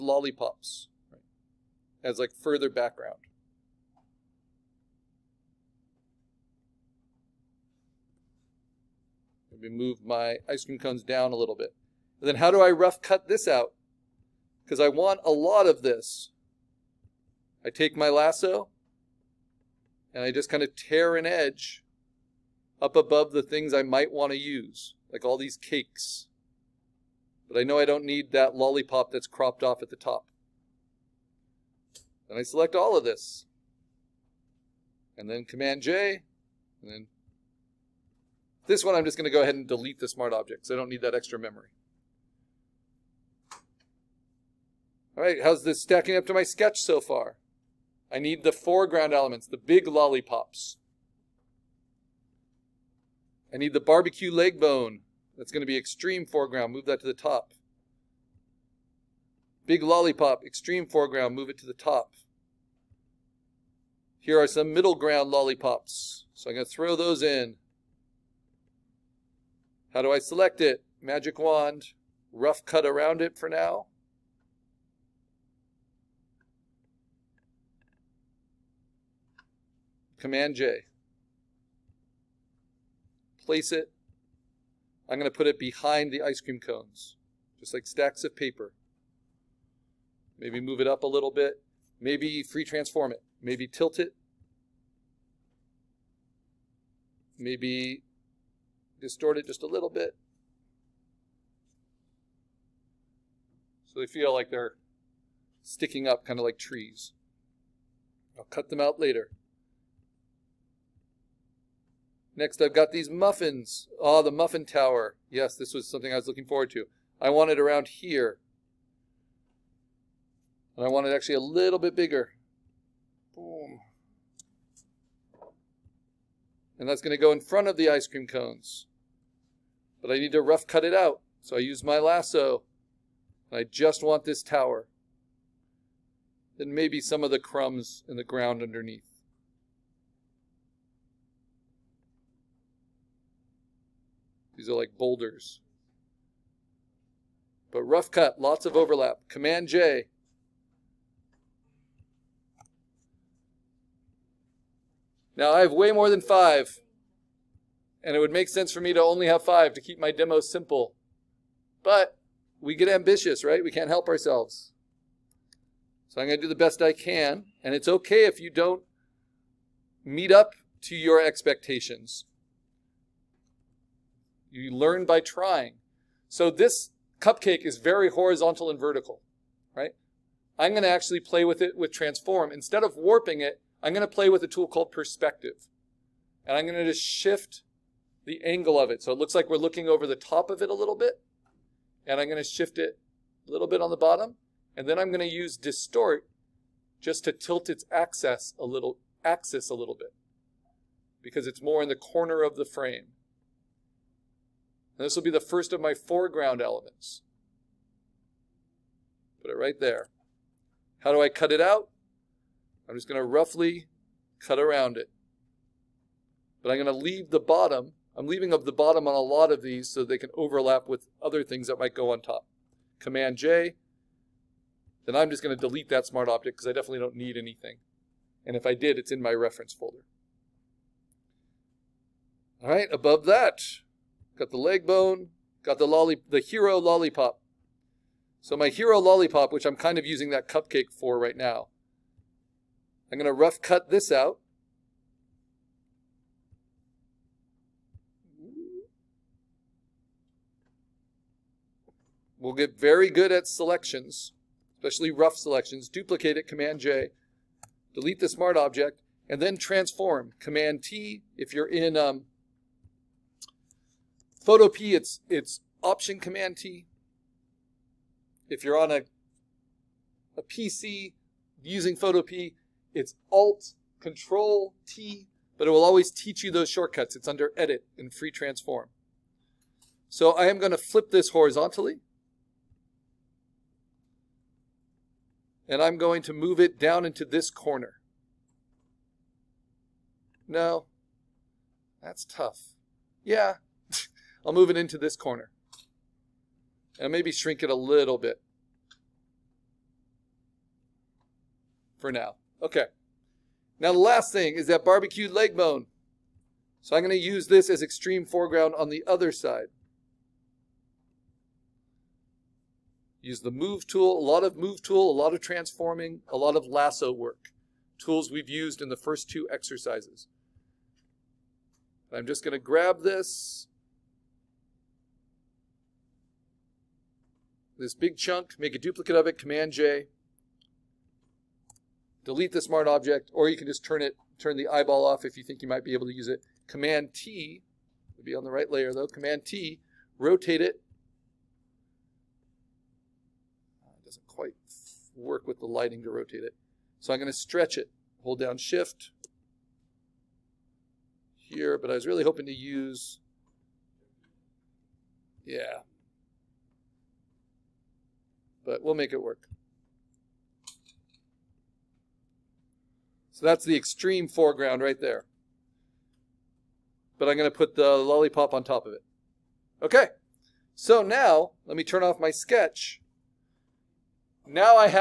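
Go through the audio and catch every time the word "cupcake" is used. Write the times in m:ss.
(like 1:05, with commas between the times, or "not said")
2:57, 4:00.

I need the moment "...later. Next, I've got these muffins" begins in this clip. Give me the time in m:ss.
1:48.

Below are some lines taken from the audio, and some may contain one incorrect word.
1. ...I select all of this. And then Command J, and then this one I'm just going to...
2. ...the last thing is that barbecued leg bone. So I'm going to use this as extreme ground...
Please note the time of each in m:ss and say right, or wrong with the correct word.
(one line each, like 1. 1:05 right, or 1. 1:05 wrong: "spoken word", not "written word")
1. 0:32 right
2. 5:03 wrong: "foreground", not "ground".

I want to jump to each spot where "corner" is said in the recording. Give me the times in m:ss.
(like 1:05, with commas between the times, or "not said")
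3:21, 4:47, 4:55.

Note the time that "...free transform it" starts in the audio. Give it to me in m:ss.
1:32.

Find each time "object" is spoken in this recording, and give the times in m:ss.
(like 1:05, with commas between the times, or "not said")
0:40, 3:46, 4:18, 5:32.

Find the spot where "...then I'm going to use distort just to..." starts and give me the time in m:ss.
3:14.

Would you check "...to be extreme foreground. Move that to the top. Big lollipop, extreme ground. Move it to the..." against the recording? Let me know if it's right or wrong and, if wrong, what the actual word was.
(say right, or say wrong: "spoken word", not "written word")
wrong: "foreground", not "ground".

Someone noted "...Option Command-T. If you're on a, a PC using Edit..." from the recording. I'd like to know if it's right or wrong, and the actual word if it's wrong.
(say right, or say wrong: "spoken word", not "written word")
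wrong: "Photopea", not "Edit".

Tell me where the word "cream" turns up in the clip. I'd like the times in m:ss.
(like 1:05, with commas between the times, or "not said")
0:10, 1:26, 2:08.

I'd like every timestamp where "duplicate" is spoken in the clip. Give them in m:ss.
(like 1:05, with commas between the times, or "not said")
4:15, 5:28.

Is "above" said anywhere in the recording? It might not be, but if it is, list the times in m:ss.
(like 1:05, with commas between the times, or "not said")
0:22, 3:52.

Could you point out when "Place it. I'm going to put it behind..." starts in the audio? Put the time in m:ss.
1:23.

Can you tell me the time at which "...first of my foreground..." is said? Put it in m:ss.
3:25.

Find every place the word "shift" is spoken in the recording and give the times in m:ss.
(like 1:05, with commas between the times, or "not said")
3:07, 3:12, 5:48.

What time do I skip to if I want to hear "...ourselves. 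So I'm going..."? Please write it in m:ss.
2:44.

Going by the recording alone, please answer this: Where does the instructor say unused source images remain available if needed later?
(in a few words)
reference folder.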